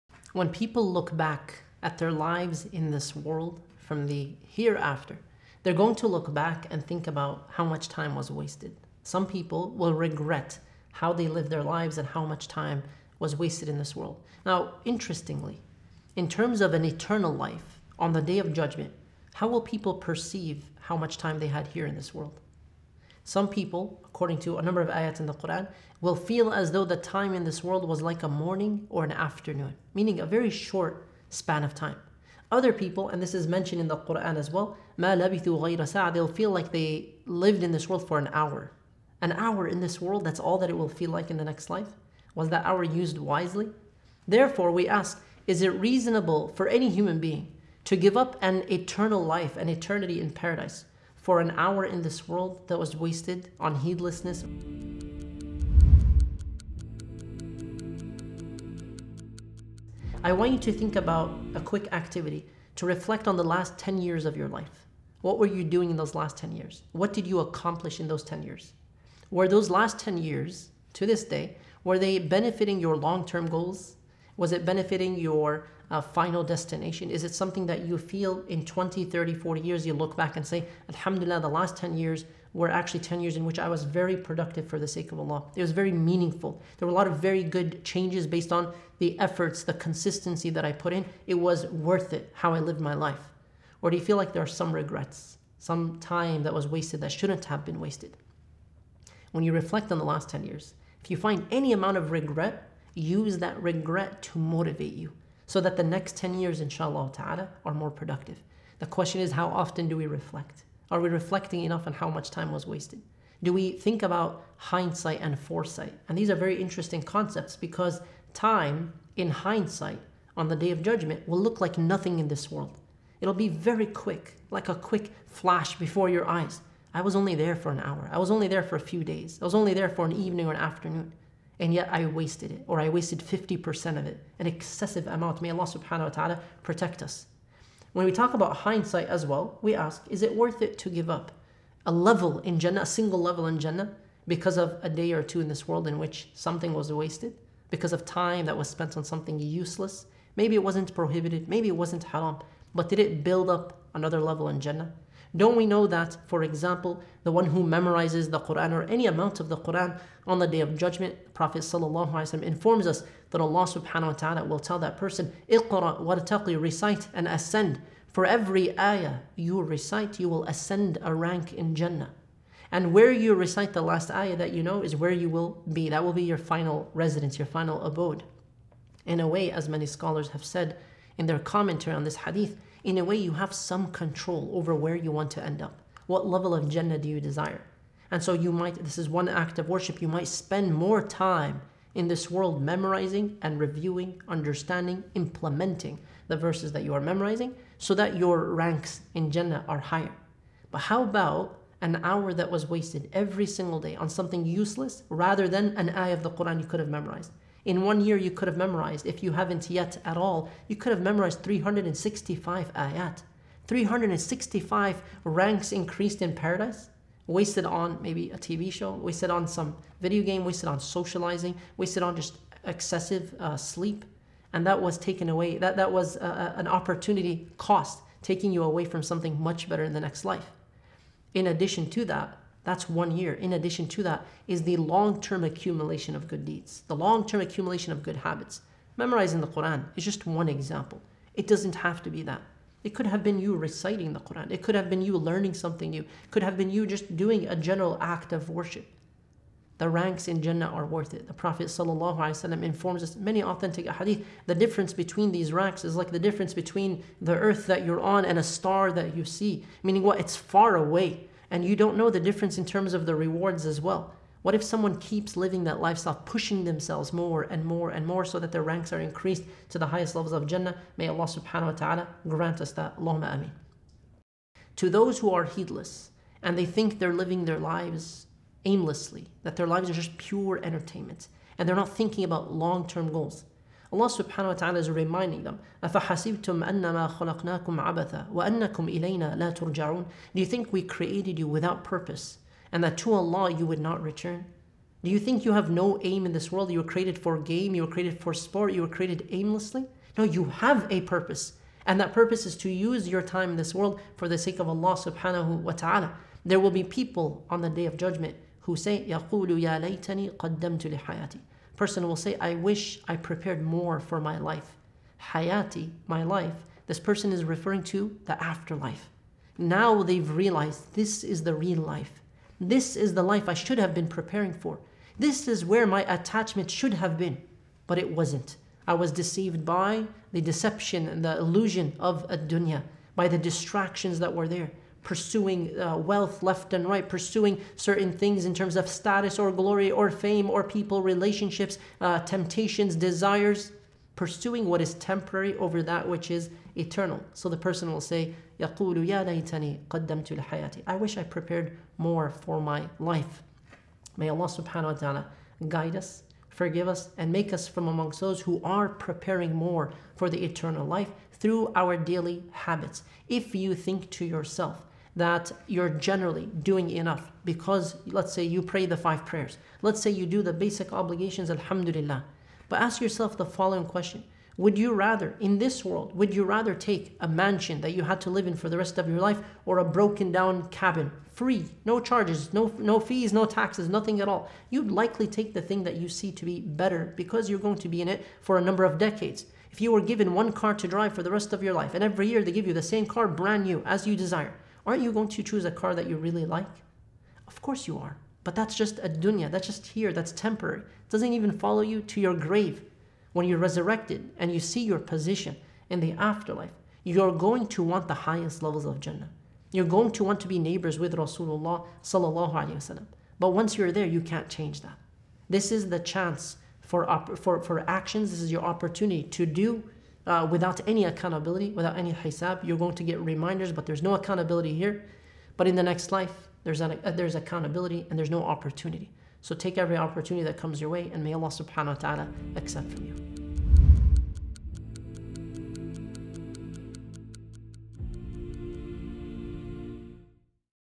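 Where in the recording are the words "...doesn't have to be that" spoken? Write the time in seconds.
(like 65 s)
241 s.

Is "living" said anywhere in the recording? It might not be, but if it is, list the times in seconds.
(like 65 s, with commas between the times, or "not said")
265 s, 277 s.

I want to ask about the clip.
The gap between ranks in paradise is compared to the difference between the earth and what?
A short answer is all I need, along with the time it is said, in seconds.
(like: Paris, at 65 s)
a star, at 258 s.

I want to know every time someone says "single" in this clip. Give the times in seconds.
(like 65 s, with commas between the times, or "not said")
142 s, 203 s.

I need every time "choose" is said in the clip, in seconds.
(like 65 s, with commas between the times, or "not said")
395 s.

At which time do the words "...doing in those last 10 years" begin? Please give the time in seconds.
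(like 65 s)
65 s.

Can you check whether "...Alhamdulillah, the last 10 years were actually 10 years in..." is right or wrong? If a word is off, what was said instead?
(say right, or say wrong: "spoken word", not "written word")
right.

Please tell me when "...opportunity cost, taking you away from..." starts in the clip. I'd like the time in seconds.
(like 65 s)
226 s.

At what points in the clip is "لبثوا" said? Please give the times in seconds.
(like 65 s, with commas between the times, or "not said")
35 s.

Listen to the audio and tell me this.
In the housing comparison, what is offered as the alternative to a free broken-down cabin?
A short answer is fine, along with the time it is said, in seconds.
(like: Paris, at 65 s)
a mansion, at 377 s.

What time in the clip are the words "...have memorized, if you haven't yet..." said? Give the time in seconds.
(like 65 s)
208 s.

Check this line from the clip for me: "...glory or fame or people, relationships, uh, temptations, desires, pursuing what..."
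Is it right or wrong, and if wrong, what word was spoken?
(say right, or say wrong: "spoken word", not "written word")
right.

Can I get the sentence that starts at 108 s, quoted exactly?
The question is, how often do we reflect?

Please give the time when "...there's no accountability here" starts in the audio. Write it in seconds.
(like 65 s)
423 s.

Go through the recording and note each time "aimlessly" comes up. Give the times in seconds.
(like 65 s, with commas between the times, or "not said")
278 s, 299 s.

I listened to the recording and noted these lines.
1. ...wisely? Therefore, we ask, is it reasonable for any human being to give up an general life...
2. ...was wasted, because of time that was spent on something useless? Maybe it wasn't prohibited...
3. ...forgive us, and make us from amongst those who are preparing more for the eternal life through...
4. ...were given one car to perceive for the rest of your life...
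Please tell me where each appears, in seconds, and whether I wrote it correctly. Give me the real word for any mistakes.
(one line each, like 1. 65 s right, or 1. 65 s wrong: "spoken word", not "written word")
1. 43 s wrong: "eternal", not "general"
2. 146 s right
3. 356 s right
4. 389 s wrong: "drive", not "perceive".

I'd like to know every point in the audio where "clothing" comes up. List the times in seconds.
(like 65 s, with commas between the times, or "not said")
not said.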